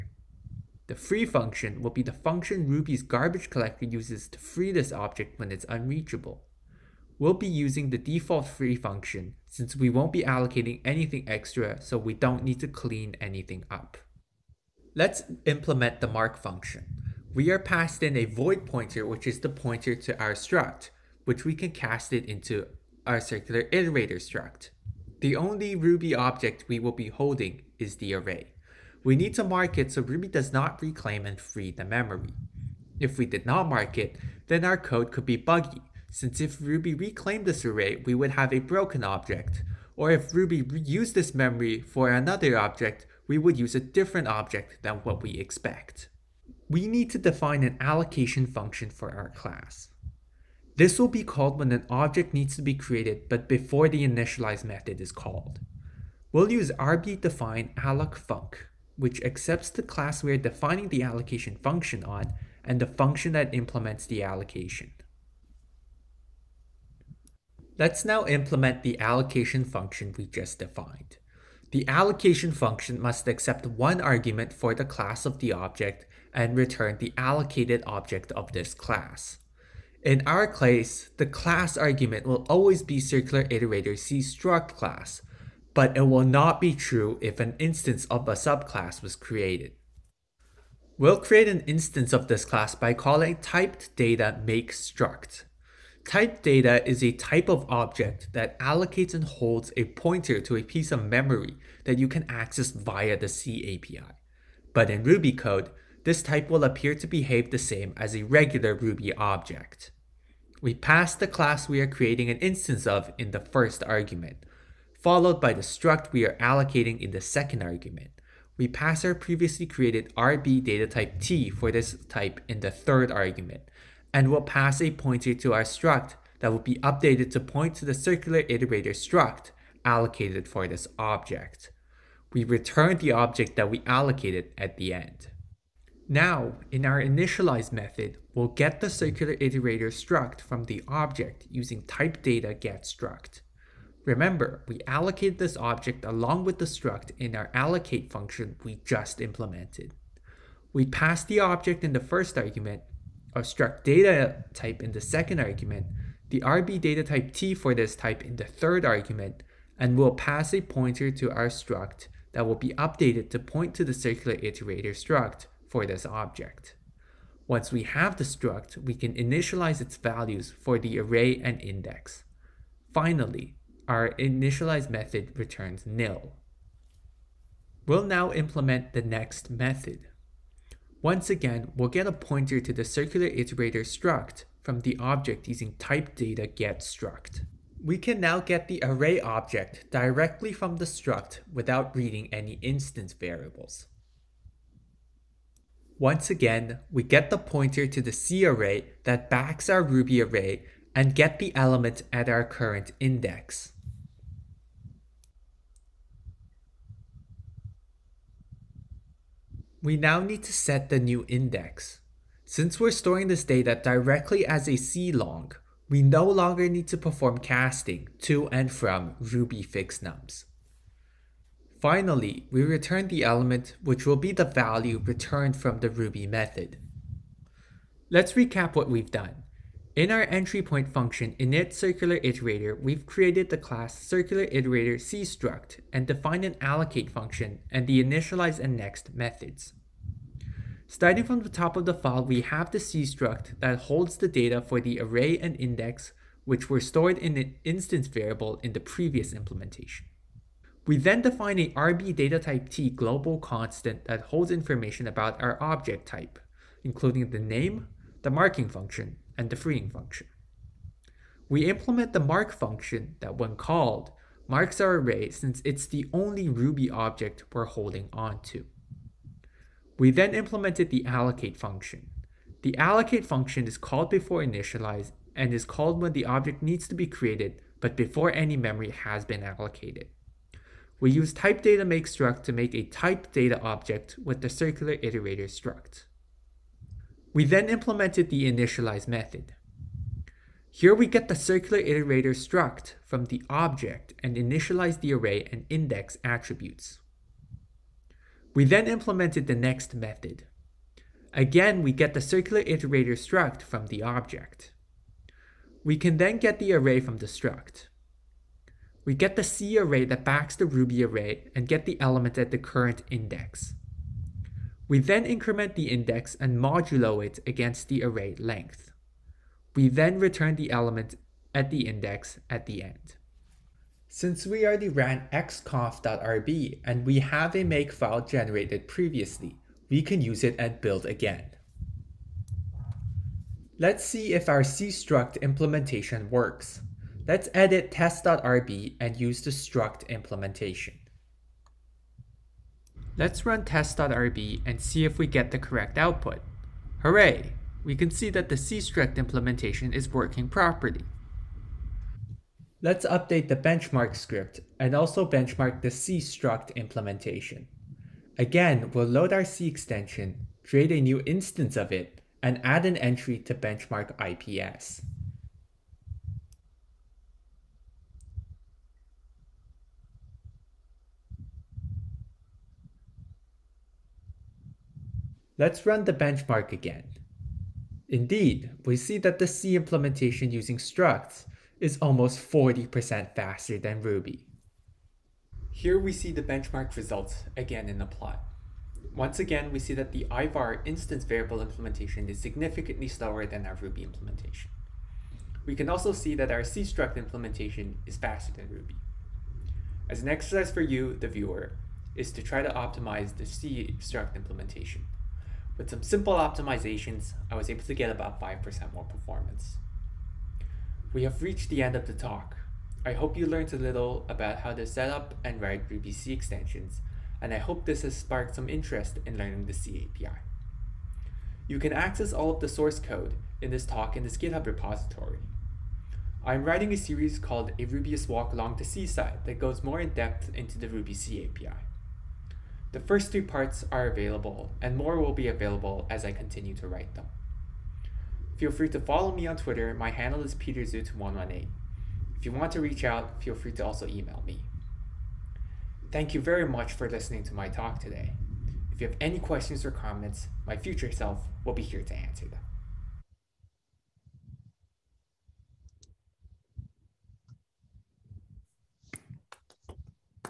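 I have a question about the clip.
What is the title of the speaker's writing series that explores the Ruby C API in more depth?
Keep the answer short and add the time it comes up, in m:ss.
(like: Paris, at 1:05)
A Rubyist Walk Along the C-side, at 7:07.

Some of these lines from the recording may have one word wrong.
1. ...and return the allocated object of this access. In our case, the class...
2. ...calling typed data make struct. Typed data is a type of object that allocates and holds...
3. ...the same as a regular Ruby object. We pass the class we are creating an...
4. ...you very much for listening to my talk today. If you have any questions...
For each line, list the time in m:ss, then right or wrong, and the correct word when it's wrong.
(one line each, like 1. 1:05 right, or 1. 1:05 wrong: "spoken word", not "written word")
1. 1:16 wrong: "class", not "access"
2. 1:32 right
3. 1:47 right
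4. 7:26 right.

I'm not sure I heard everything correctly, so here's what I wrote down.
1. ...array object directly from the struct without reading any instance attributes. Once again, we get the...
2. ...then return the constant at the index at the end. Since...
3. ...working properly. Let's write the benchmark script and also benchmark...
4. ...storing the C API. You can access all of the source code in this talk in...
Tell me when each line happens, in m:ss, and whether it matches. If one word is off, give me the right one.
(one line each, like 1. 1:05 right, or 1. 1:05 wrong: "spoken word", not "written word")
1. 3:08 wrong: "variables", not "attributes"
2. 5:19 wrong: "element", not "constant"
3. 5:50 wrong: "update", not "write"
4. 6:59 wrong: "learning", not "storing".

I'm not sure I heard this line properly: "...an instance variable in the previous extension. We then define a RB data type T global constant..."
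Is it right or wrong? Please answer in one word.
wrong.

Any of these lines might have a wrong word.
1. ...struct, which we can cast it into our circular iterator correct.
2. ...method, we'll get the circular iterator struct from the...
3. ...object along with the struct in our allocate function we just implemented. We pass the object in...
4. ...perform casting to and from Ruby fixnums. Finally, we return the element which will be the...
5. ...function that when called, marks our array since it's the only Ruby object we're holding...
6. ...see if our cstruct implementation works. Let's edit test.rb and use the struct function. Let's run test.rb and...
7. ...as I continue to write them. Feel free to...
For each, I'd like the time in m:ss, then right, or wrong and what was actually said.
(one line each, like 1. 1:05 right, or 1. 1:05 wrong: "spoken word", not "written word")
1. 0:20 wrong: "struct", not "correct"
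2. 2:17 right
3. 2:25 right
4. 3:36 right
5. 4:22 right
6. 5:34 wrong: "implementation", not "function"
7. 7:16 right.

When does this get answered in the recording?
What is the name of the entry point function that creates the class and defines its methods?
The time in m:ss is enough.
3:51.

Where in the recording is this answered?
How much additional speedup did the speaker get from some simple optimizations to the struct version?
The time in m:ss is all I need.
6:48.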